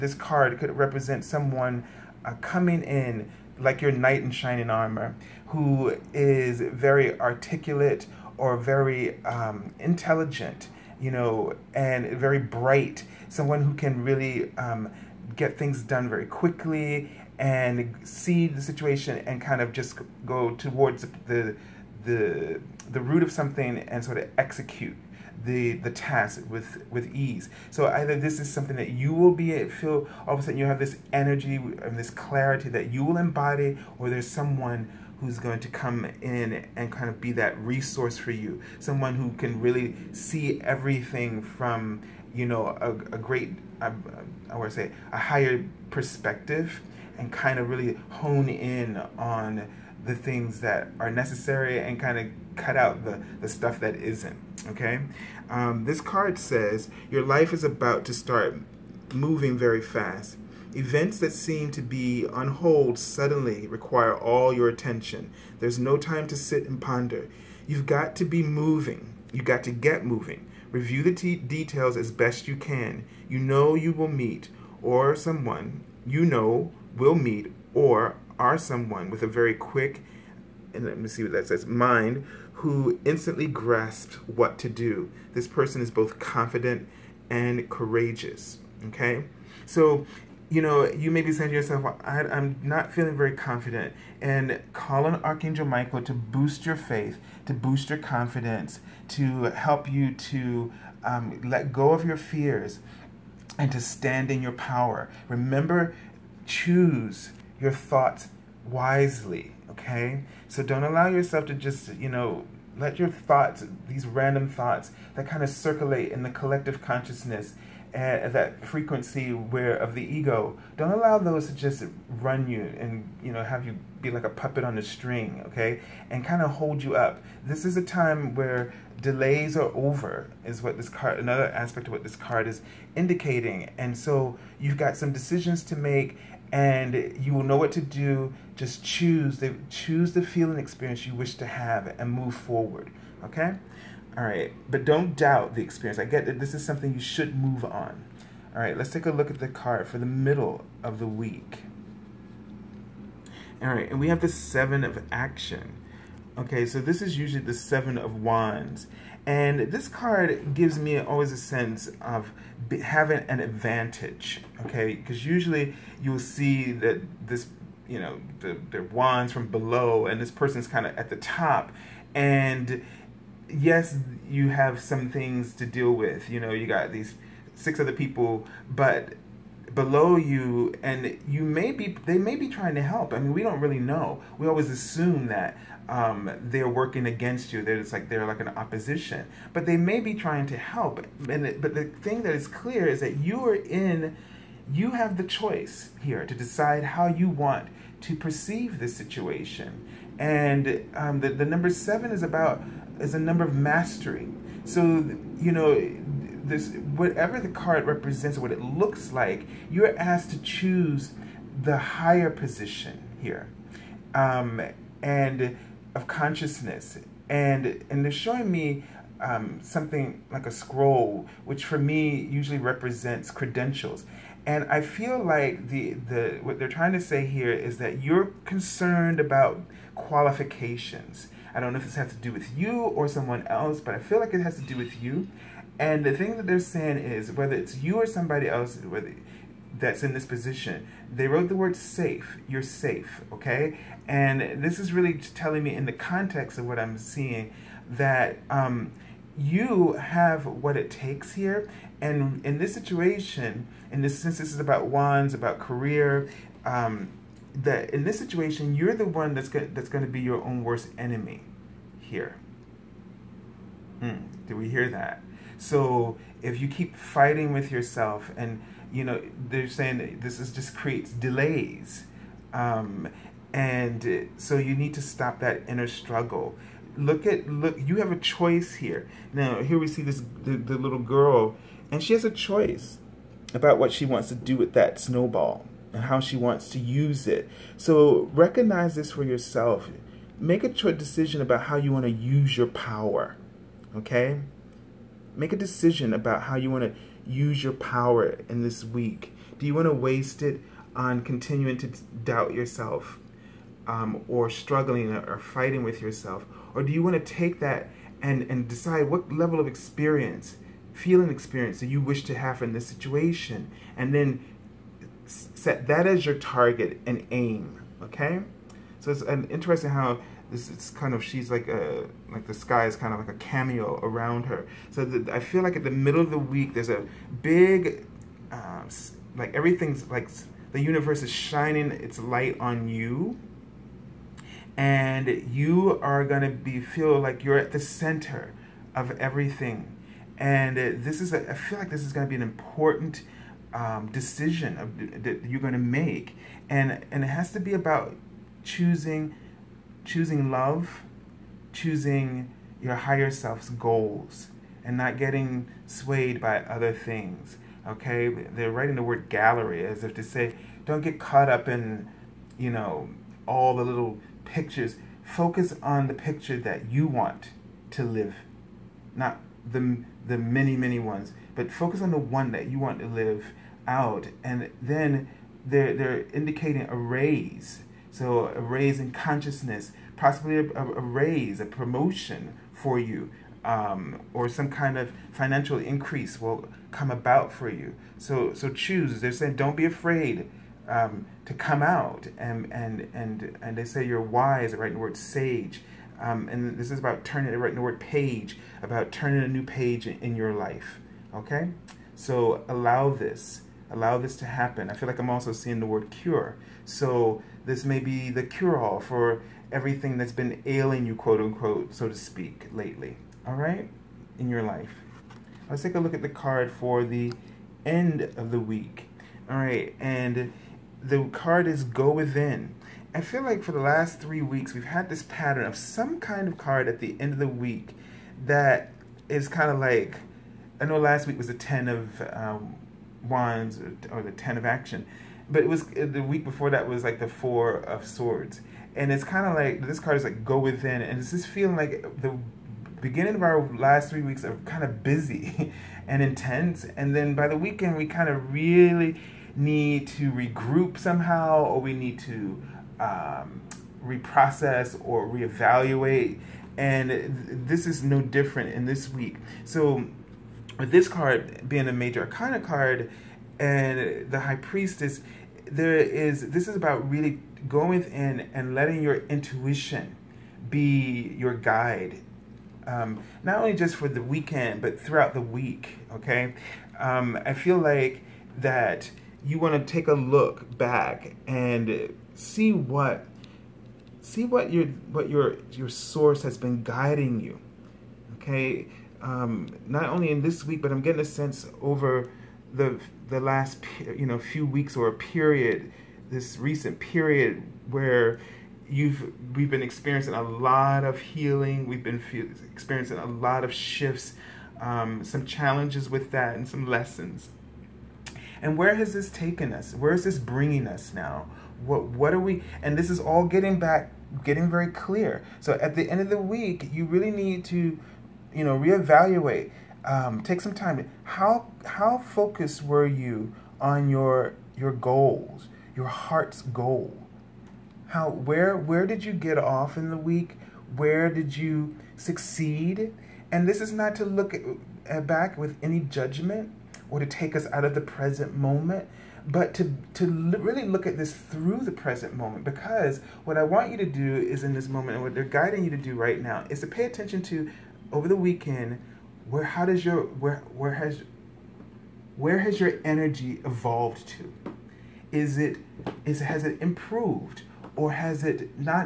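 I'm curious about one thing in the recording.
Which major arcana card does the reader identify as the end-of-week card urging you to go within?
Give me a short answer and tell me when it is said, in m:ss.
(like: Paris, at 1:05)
The High Priestess, at 7:44.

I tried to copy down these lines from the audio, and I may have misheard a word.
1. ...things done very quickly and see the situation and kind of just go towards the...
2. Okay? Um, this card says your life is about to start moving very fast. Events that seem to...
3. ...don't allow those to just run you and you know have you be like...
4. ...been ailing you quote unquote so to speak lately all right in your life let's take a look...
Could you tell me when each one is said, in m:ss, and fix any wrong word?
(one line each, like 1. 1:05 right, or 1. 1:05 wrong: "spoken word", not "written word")
1. 0:15 right
2. 0:54 right
3. 2:00 right
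4. 6:50 right.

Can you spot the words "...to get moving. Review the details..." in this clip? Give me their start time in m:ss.
1:09.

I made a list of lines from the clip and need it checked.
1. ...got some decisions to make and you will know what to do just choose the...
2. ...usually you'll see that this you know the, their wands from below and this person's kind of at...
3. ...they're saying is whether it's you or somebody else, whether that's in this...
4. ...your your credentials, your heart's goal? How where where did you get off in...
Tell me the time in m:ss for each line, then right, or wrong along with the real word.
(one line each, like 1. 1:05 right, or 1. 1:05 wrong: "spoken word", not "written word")
1. 2:14 right
2. 2:45 right
3. 3:56 right
4. 8:44 wrong: "goals", not "credentials".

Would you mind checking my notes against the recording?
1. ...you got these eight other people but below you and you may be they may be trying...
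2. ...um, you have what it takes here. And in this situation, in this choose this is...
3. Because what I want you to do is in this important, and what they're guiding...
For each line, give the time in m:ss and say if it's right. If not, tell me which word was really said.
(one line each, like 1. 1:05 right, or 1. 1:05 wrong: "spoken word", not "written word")
1. 2:56 wrong: "six", not "eight"
2. 4:08 wrong: "sense", not "choose"
3. 9:02 wrong: "moment", not "important".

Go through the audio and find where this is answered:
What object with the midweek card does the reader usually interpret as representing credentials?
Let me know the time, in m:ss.
3:40.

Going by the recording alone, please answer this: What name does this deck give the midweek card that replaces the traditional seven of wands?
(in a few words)
Seven of Action.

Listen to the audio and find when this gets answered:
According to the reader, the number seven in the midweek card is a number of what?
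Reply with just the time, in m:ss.
3:23.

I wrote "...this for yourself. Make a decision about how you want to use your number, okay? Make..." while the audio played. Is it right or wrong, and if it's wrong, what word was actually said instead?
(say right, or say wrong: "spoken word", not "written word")
wrong: "power", not "number".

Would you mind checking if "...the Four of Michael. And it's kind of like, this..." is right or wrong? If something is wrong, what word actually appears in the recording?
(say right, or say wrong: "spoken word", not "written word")
wrong: "Swords", not "Michael".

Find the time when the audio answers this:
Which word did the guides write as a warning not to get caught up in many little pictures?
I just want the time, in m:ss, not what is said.
5:59.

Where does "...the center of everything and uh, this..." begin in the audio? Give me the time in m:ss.
5:37.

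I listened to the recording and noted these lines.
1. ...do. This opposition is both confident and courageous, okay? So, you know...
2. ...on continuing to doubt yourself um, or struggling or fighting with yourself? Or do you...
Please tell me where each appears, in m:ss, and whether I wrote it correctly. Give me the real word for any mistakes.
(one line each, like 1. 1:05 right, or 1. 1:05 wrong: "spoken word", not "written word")
1. 1:24 wrong: "person", not "opposition"
2. 5:00 right.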